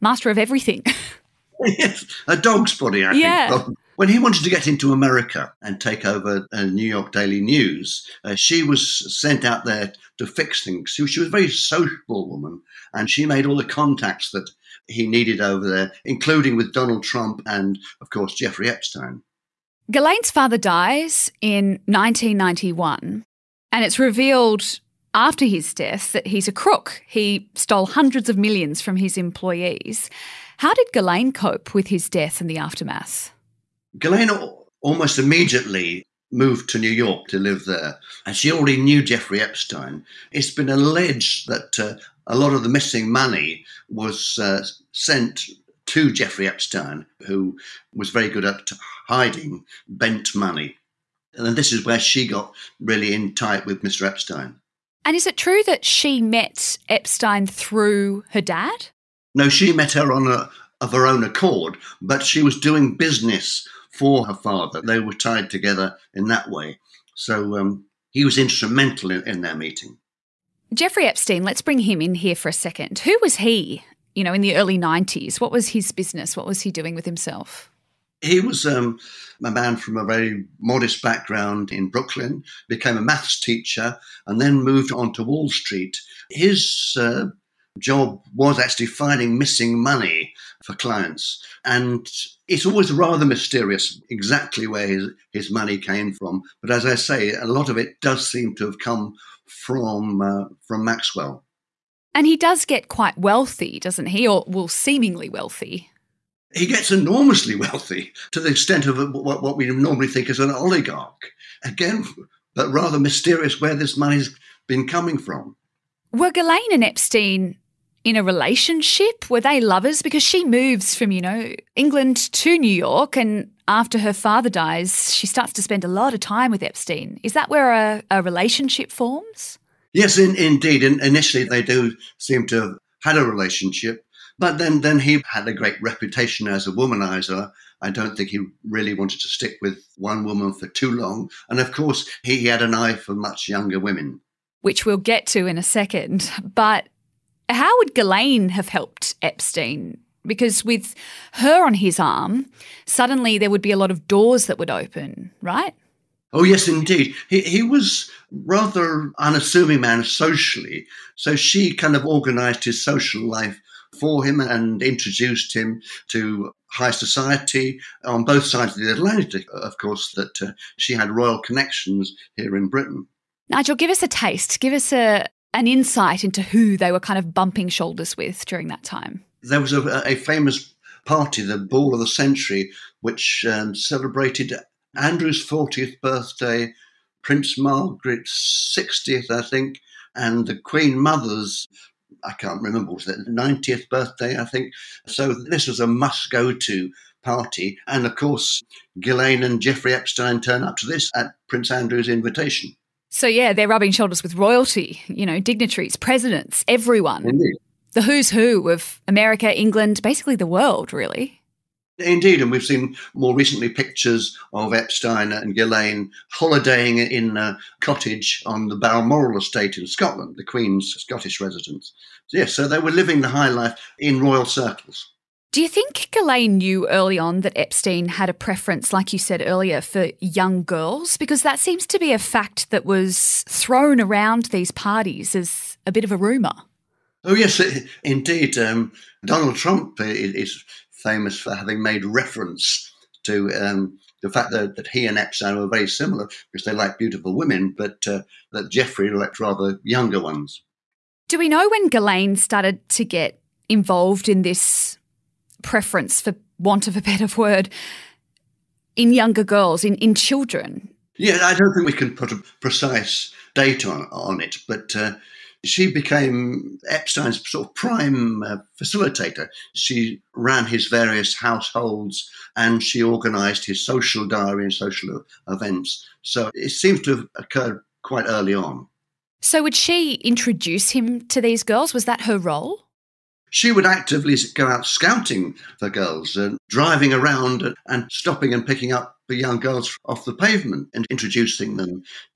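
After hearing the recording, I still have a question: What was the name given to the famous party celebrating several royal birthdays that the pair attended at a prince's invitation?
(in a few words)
Ball of the Century.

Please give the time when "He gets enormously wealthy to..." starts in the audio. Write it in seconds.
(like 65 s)
106 s.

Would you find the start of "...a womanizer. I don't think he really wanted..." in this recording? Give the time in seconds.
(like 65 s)
136 s.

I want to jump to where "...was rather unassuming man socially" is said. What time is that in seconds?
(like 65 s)
157 s.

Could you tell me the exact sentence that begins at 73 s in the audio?
Who was he, you know, in the early 90s?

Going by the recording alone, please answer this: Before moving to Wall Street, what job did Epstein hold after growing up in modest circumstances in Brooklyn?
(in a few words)
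maths teacher.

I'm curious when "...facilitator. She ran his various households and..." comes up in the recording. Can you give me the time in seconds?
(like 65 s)
268 s.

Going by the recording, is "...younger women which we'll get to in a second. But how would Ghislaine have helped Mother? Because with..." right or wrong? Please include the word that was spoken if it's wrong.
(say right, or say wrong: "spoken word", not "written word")
wrong: "Epstein", not "Mother".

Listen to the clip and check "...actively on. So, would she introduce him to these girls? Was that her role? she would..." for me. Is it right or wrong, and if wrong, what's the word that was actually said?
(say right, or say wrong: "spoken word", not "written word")
wrong: "early", not "actively".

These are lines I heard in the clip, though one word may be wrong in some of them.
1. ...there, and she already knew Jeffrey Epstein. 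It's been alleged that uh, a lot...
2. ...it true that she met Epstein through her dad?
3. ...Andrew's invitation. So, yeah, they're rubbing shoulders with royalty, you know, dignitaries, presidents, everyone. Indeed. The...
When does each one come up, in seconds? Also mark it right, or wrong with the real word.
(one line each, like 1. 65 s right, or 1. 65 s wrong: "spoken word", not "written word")
1. 37 s right
2. 55 s right
3. 201 s right.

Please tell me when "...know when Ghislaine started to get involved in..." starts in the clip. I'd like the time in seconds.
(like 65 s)
251 s.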